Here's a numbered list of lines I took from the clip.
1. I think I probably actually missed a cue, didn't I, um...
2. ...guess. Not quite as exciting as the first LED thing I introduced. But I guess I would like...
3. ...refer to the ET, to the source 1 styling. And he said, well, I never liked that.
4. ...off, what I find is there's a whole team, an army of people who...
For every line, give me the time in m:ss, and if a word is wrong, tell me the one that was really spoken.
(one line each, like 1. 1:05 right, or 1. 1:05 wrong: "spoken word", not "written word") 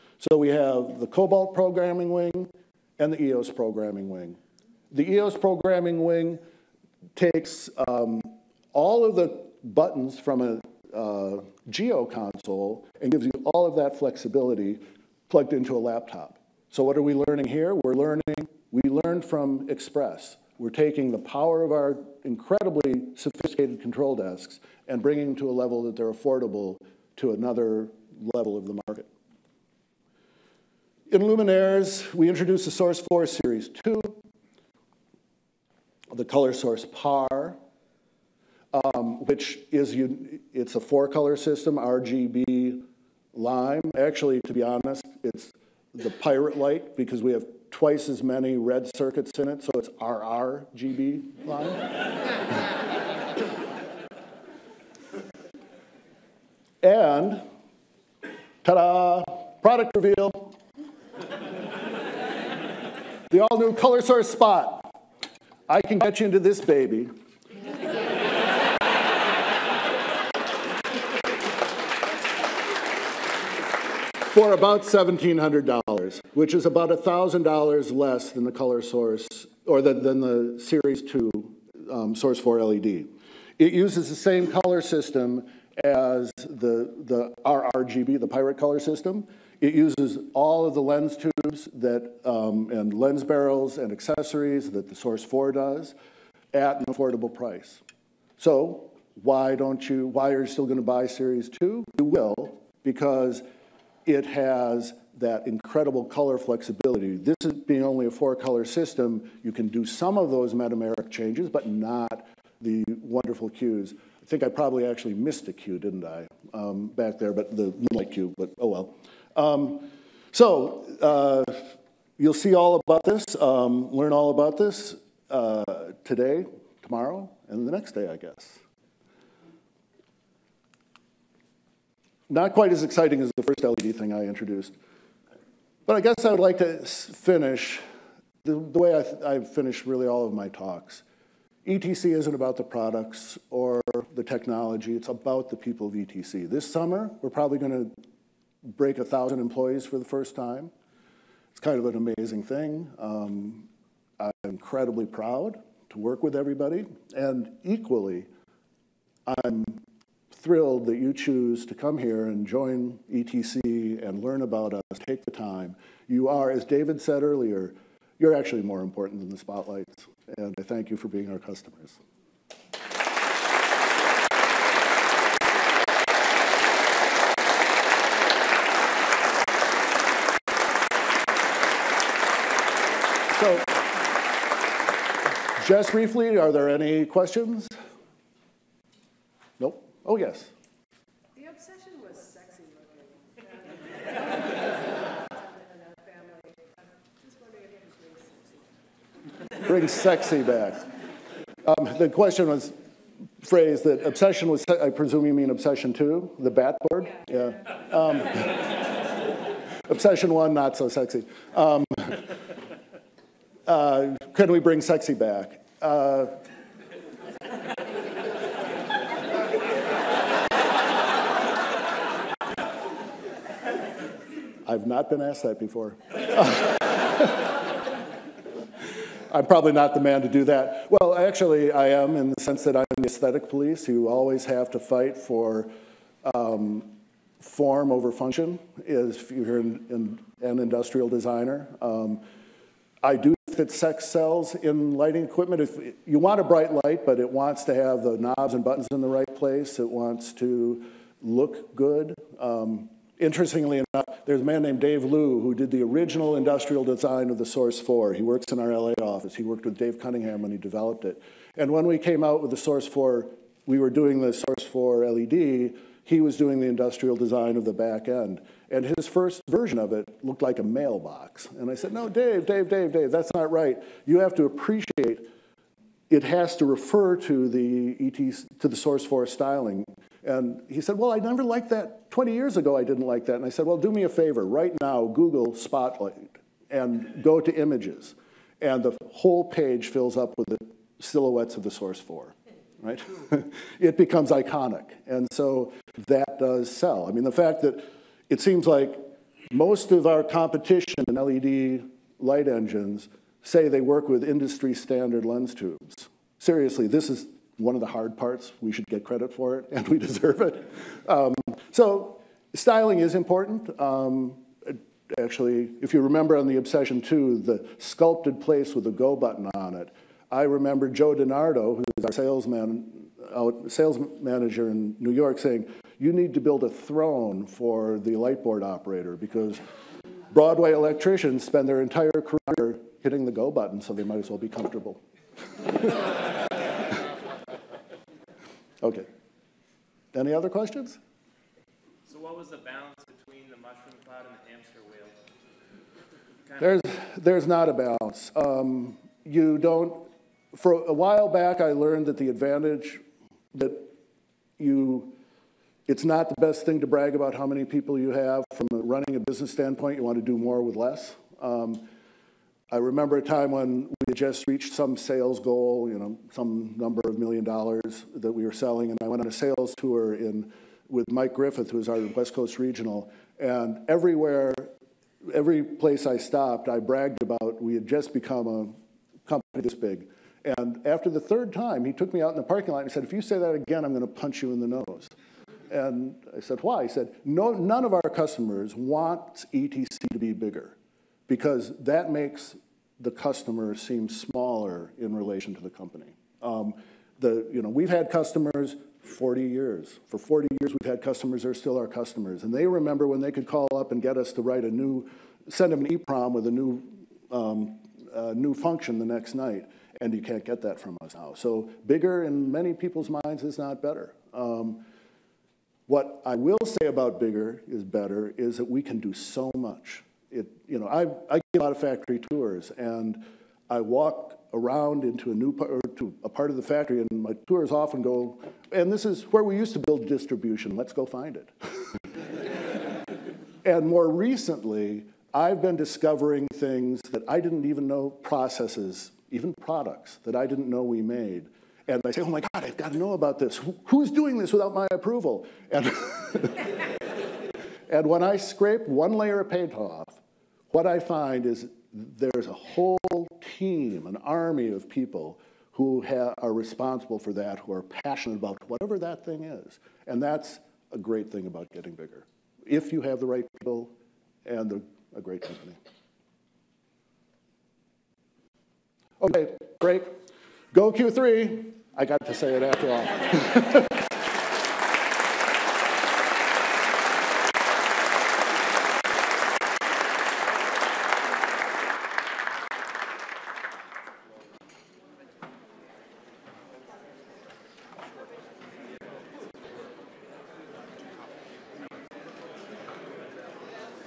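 1. 1:54 right
2. 2:08 right
3. 4:36 wrong: "4", not "1"
4. 7:29 right.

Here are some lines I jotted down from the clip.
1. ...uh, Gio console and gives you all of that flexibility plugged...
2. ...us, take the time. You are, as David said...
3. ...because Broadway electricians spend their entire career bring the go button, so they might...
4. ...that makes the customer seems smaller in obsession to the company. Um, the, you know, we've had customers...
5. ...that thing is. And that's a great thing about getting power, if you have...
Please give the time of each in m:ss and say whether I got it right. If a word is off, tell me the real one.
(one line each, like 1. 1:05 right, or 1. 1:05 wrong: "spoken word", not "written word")
1. 0:10 right
2. 2:44 right
3. 5:29 wrong: "hitting", not "bring"
4. 6:31 wrong: "relation", not "obsession"
5. 7:38 wrong: "bigger", not "power".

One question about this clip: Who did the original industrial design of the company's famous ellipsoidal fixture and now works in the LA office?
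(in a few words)
Dave Liu.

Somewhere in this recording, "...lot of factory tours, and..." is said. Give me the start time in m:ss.
7:01.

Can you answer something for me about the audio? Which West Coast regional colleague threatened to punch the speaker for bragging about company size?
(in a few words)
Mike Griffith.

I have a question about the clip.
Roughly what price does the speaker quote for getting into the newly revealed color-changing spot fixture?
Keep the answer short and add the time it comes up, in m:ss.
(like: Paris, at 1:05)
$1,700, at 1:14.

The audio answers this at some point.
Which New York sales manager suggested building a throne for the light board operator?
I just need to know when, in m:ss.
5:20.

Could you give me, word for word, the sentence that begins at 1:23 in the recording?
It uses the same color system as the, the RRGB, the pirate color system.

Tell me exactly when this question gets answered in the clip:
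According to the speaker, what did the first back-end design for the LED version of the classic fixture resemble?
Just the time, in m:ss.
4:30.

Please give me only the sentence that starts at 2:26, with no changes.
This summer, we're probably gonna break 1,000 employees for the first time.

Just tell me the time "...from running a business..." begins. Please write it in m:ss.
5:58.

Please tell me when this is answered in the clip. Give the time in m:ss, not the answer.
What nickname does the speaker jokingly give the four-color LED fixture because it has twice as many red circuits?
0:45.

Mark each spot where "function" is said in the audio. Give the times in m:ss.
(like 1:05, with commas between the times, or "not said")
3:58, 6:48.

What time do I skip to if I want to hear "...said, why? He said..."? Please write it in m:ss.
6:26.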